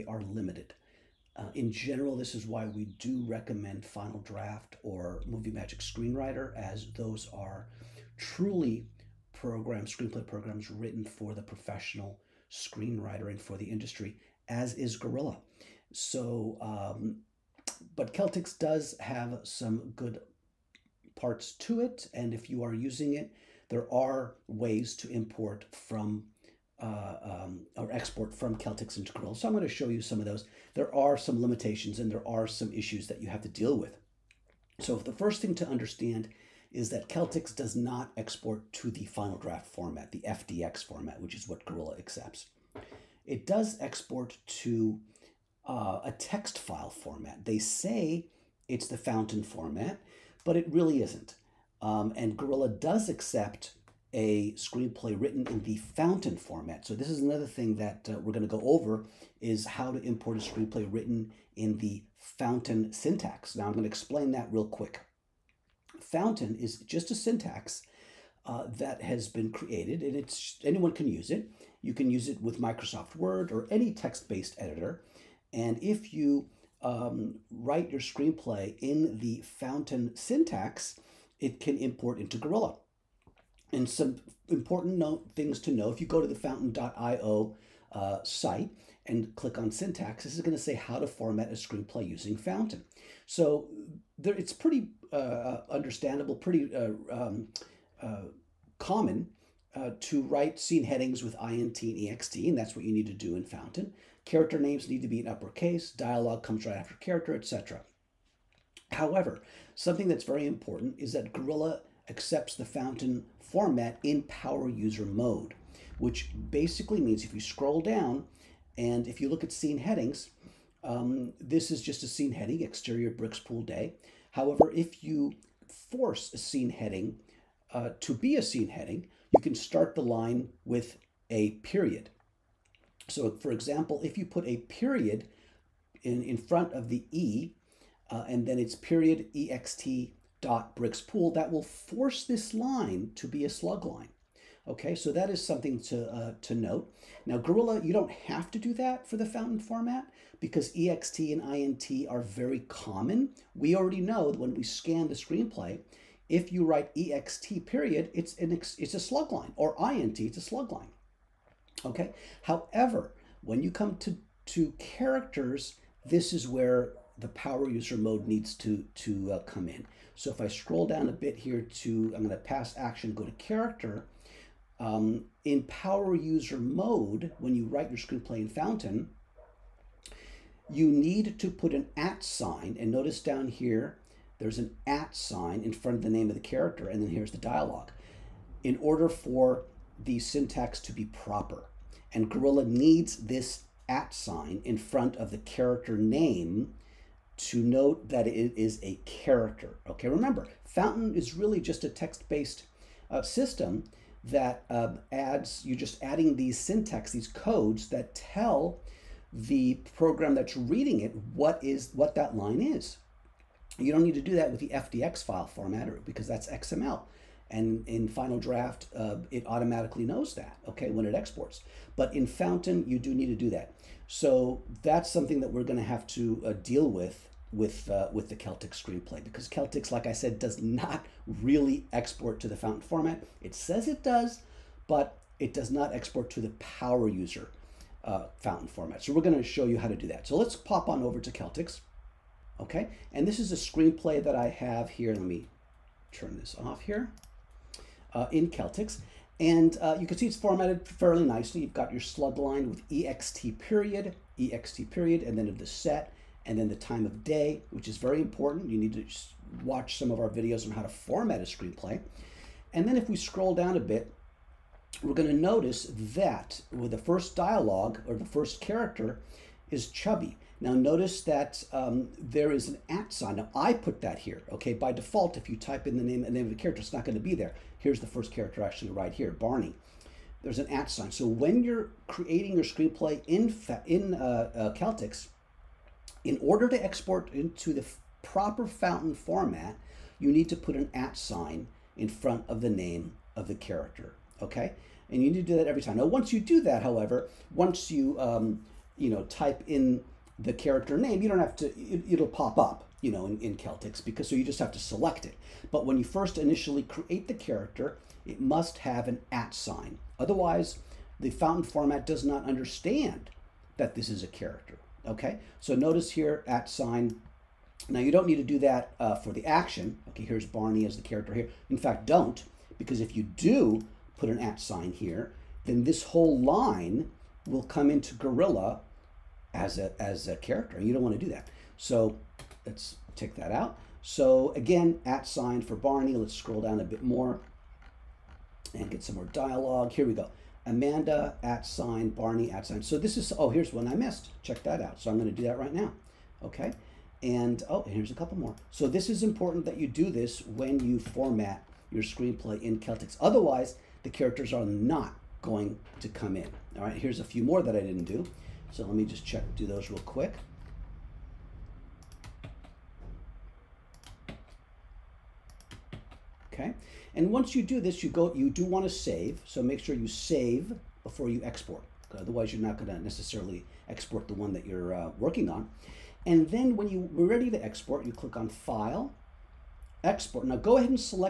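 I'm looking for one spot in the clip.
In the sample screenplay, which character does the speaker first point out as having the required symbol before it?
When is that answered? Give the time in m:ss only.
4:29.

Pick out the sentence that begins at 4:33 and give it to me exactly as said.
Now I put that here, okay?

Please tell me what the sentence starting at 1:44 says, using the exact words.
Character names need to be in uppercase, dialogue comes right after character, etc.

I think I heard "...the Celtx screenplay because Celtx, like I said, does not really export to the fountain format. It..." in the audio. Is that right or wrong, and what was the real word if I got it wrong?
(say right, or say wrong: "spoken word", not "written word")
right.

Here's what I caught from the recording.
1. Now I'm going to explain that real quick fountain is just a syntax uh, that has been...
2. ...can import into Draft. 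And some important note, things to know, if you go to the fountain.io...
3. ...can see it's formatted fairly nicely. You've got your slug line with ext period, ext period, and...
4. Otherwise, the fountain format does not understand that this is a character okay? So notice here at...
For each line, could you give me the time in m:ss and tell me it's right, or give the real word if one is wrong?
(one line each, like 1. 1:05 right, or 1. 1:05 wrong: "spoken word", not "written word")
1. 1:03 right
2. 1:21 wrong: "Gorilla", not "Draft"
3. 4:10 right
4. 5:10 right.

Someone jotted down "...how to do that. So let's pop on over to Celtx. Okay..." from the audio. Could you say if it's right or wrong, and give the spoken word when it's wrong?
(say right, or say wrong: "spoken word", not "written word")
right.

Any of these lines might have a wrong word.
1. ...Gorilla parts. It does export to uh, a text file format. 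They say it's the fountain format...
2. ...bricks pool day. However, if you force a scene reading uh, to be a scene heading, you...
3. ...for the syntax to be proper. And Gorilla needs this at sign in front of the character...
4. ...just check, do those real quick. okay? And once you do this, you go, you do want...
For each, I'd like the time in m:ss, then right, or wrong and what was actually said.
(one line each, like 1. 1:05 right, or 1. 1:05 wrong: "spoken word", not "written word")
1. 0:41 wrong: "accepts", not "parts"
2. 2:03 wrong: "heading", not "reading"
3. 3:09 right
4. 5:59 right.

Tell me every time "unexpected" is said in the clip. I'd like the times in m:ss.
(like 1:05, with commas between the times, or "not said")
not said.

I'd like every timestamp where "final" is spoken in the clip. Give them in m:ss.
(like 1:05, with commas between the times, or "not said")
0:03, 0:39, 3:38.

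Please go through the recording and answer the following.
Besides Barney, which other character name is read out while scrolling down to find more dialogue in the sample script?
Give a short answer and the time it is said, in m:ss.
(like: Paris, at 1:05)
Amanda, at 5:40.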